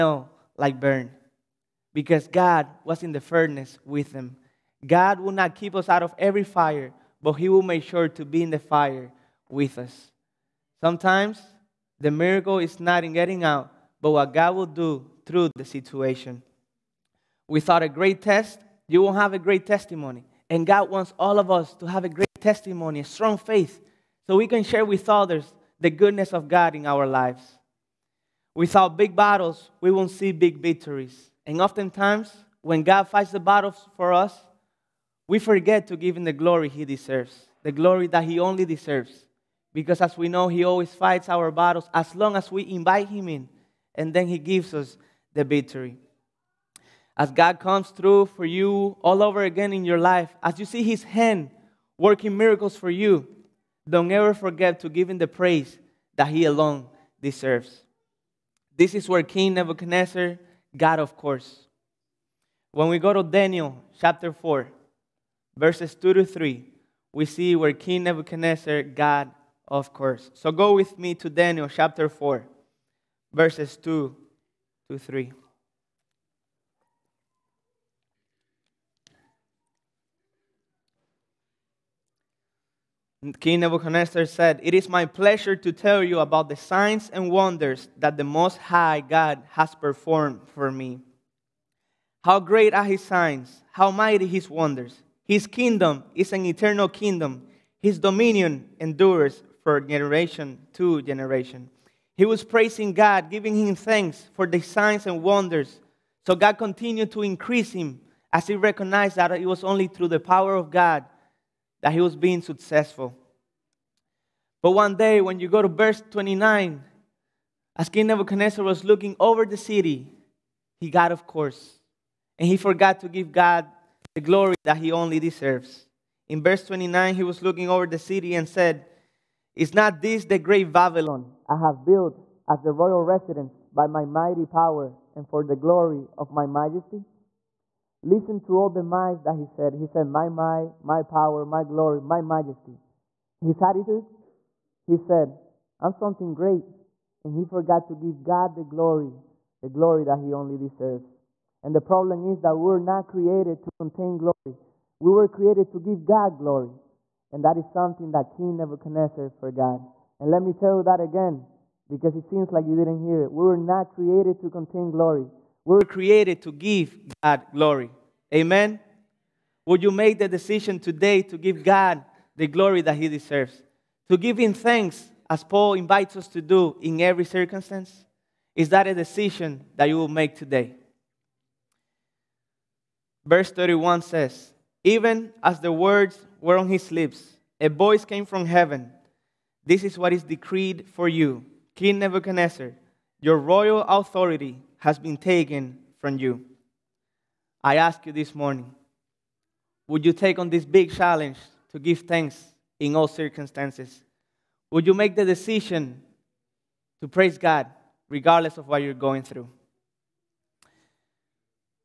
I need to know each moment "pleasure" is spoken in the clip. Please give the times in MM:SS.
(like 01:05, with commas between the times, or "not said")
01:25.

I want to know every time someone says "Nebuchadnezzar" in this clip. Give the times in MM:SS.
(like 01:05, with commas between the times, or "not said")
00:59, 01:08, 01:23, 01:58, 02:38, 03:11.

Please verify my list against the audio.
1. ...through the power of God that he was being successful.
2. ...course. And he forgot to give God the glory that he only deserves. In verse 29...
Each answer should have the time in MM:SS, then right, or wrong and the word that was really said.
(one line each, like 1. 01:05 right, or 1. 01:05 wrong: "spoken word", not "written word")
1. 01:49 right
2. 02:01 right.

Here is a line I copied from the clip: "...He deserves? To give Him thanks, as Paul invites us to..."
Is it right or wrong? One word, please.
right.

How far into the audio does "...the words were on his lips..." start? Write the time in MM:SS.
03:05.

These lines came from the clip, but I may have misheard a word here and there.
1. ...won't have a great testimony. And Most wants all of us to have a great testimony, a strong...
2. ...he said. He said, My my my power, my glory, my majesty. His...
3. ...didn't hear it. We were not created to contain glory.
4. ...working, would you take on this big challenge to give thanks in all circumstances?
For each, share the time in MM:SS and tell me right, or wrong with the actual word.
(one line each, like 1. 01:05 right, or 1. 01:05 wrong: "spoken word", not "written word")
1. 00:19 wrong: "God", not "Most"
2. 02:19 right
3. 02:42 right
4. 03:18 wrong: "morning", not "working".